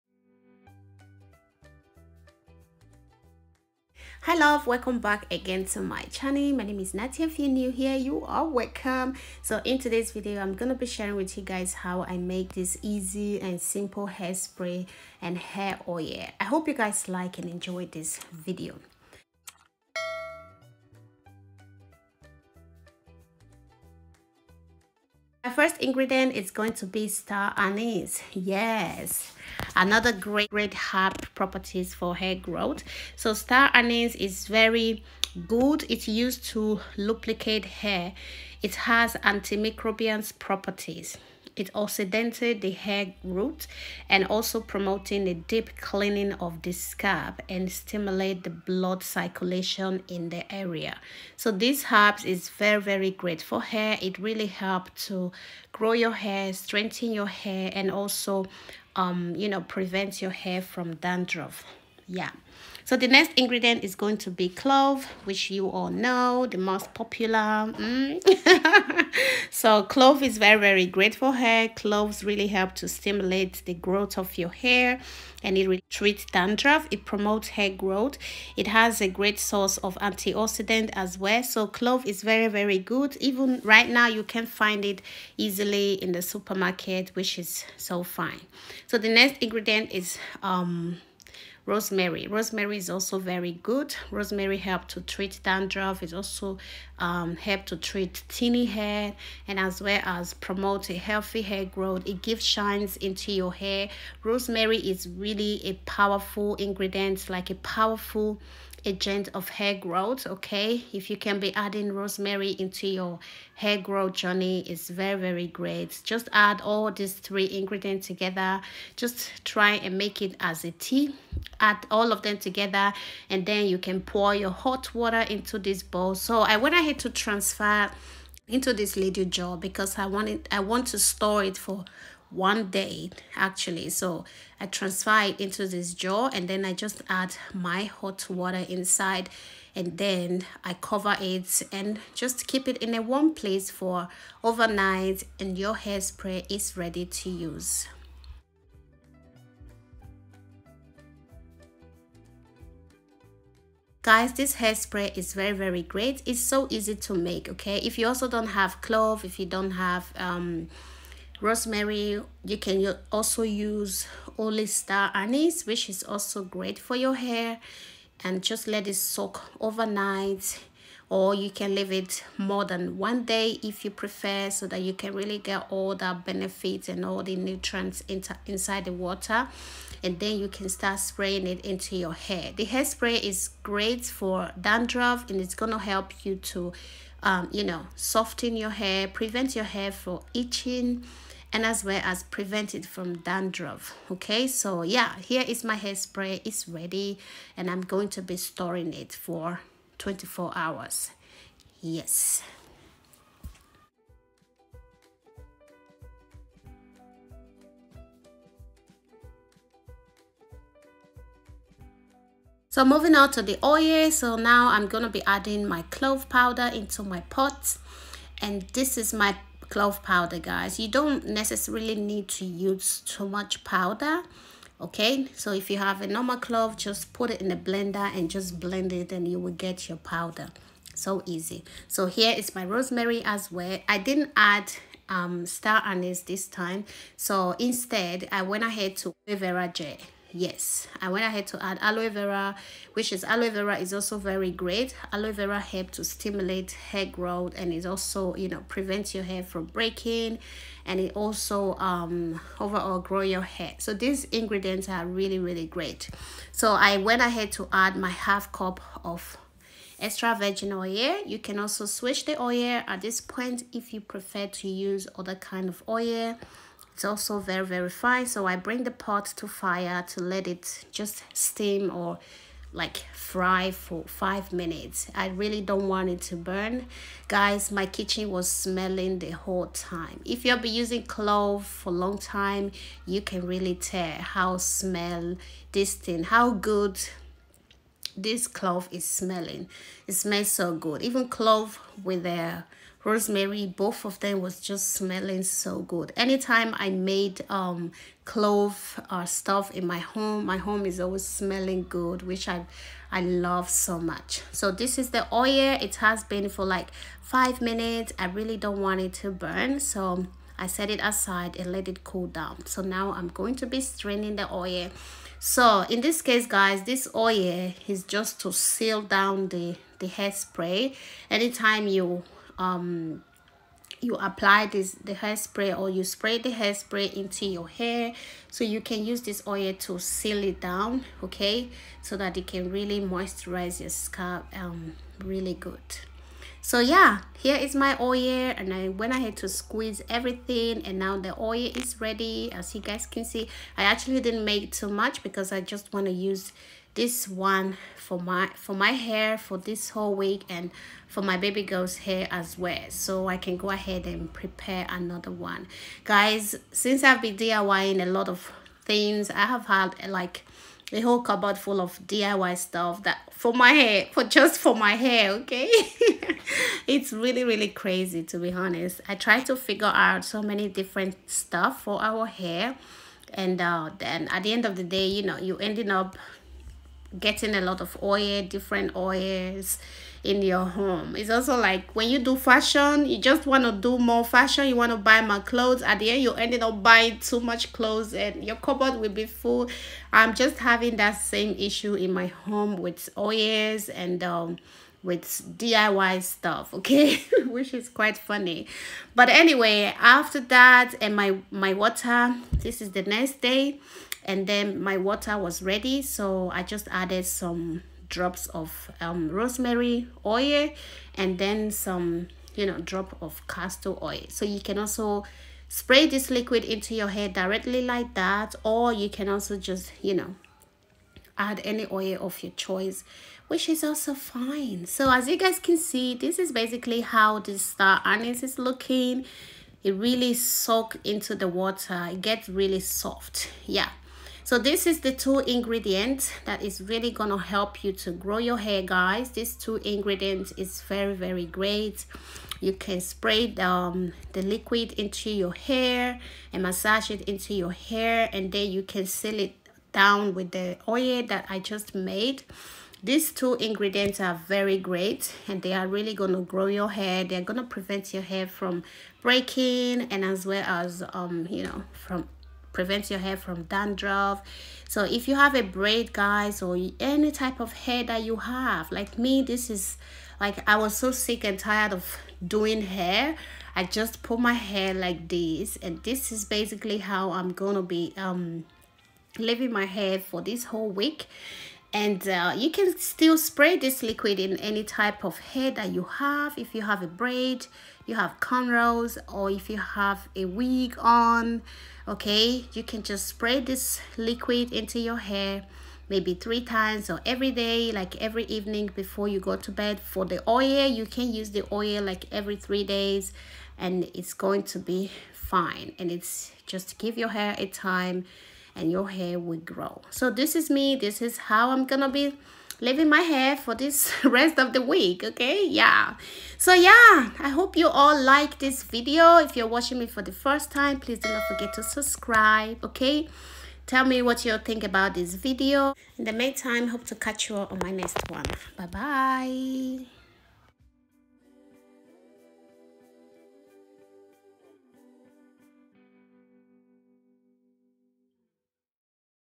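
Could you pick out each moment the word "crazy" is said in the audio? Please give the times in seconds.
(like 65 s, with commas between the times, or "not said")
367 s.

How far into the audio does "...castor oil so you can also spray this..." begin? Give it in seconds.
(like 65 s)
413 s.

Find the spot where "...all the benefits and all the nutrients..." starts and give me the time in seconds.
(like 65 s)
175 s.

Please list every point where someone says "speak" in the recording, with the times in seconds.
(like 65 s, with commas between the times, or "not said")
not said.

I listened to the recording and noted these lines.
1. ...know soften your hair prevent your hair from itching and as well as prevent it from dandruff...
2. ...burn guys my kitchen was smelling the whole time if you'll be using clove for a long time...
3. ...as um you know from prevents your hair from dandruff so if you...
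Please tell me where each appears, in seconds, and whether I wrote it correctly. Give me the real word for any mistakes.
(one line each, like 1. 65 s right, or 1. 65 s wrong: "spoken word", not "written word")
1. 187 s right
2. 276 s right
3. 460 s right.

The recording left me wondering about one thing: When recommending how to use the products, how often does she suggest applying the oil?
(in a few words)
Every 3 days.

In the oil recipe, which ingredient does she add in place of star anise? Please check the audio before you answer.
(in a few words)
Aloe vera gel.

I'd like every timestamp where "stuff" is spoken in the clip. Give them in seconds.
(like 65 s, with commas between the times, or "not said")
299 s, 362 s, 371 s, 396 s.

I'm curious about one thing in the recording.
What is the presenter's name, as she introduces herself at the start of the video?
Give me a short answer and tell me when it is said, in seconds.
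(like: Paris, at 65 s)
Natia, at 6 s.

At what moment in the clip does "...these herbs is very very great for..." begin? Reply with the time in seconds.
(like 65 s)
51 s.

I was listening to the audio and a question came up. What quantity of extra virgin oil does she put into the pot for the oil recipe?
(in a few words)
Half cup.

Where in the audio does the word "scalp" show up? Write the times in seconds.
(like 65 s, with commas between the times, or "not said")
46 s, 333 s.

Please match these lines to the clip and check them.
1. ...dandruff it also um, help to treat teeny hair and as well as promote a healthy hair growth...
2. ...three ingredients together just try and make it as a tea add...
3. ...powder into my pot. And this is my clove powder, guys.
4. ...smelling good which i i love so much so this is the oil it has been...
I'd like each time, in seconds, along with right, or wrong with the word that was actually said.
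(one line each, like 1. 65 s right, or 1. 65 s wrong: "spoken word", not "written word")
1. 95 s right
2. 117 s right
3. 216 s right
4. 301 s right.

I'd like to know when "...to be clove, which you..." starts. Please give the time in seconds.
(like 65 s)
64 s.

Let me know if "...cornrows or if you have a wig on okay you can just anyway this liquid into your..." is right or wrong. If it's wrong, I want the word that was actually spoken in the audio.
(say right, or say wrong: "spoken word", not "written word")
wrong: "spray", not "anyway".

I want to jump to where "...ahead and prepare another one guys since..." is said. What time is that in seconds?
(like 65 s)
353 s.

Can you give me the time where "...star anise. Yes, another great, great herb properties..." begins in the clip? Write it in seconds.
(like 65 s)
27 s.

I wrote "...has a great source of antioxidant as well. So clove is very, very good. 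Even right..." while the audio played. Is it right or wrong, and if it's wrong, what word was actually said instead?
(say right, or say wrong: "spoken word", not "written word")
right.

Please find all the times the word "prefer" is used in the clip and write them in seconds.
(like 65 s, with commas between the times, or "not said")
173 s, 264 s.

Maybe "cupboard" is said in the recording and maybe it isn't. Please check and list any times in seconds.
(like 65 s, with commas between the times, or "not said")
361 s, 388 s.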